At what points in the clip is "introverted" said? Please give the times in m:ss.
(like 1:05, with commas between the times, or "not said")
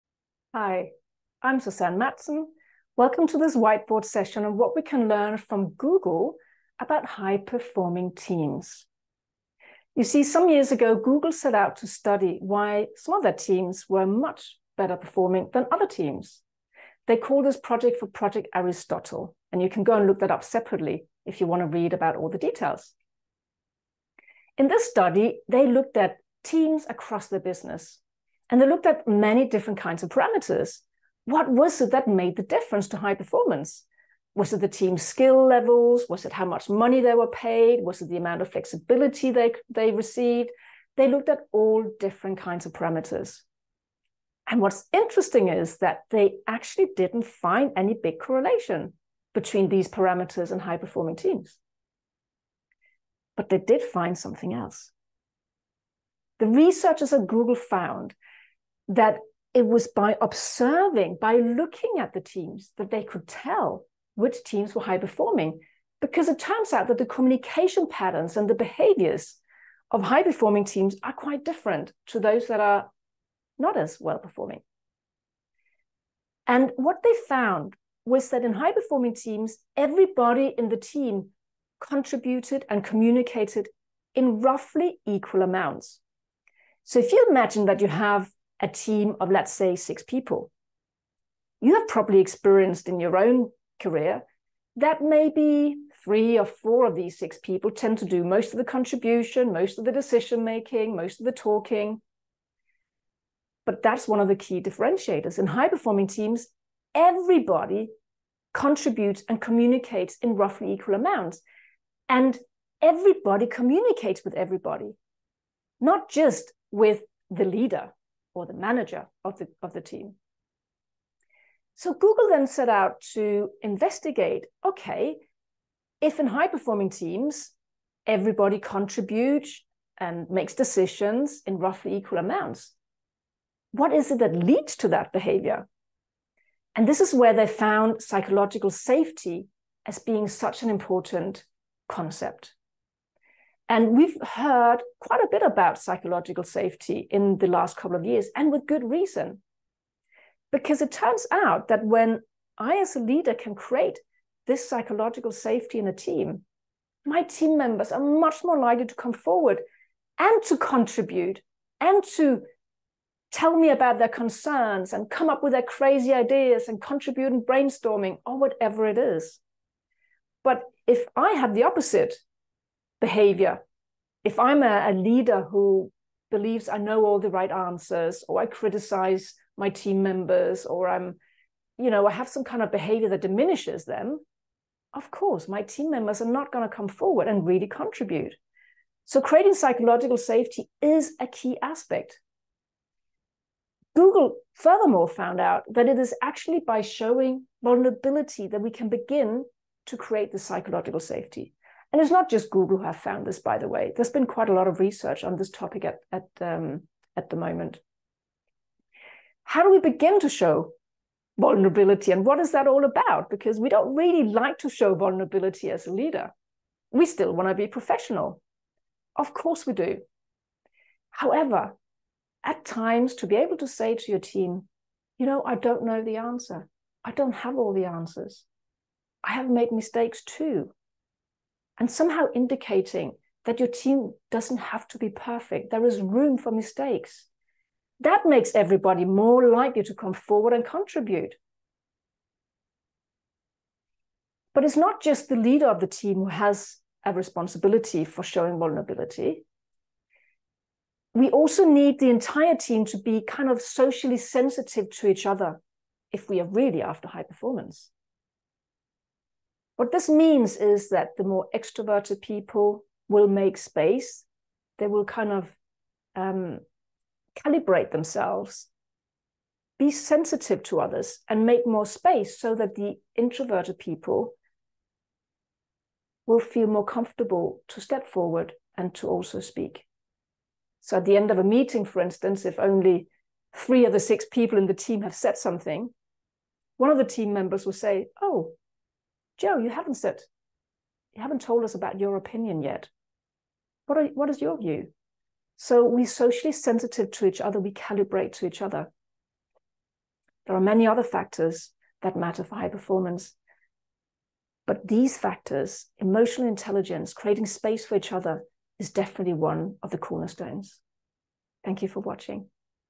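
4:33.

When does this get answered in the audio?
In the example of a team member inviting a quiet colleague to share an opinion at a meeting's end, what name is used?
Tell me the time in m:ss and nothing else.
4:49.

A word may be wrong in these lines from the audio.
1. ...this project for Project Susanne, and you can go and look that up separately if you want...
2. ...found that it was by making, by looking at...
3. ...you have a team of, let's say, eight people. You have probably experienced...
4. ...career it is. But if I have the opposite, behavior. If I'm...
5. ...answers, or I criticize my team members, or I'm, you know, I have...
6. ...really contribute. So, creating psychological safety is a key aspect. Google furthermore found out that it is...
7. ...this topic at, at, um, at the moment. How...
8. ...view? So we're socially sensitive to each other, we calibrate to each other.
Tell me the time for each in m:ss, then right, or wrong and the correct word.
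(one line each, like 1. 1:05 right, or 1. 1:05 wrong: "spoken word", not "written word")
1. 0:17 wrong: "Aristotle", not "Susanne"
2. 0:57 wrong: "observing", not "making"
3. 1:27 wrong: "six", not "eight"
4. 2:48 wrong: "whatever", not "career"
5. 2:57 right
6. 3:07 right
7. 3:25 right
8. 4:54 right.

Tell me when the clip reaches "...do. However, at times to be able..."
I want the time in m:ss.
3:39.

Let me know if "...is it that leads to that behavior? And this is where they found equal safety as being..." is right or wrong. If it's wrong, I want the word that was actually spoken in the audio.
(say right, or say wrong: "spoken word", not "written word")
wrong: "psychological", not "equal".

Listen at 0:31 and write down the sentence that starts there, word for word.
What was it that made the difference to high performance?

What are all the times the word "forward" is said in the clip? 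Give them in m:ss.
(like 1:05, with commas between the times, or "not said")
2:39, 3:06, 4:00, 4:38.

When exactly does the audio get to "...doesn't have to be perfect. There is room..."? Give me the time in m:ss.
3:54.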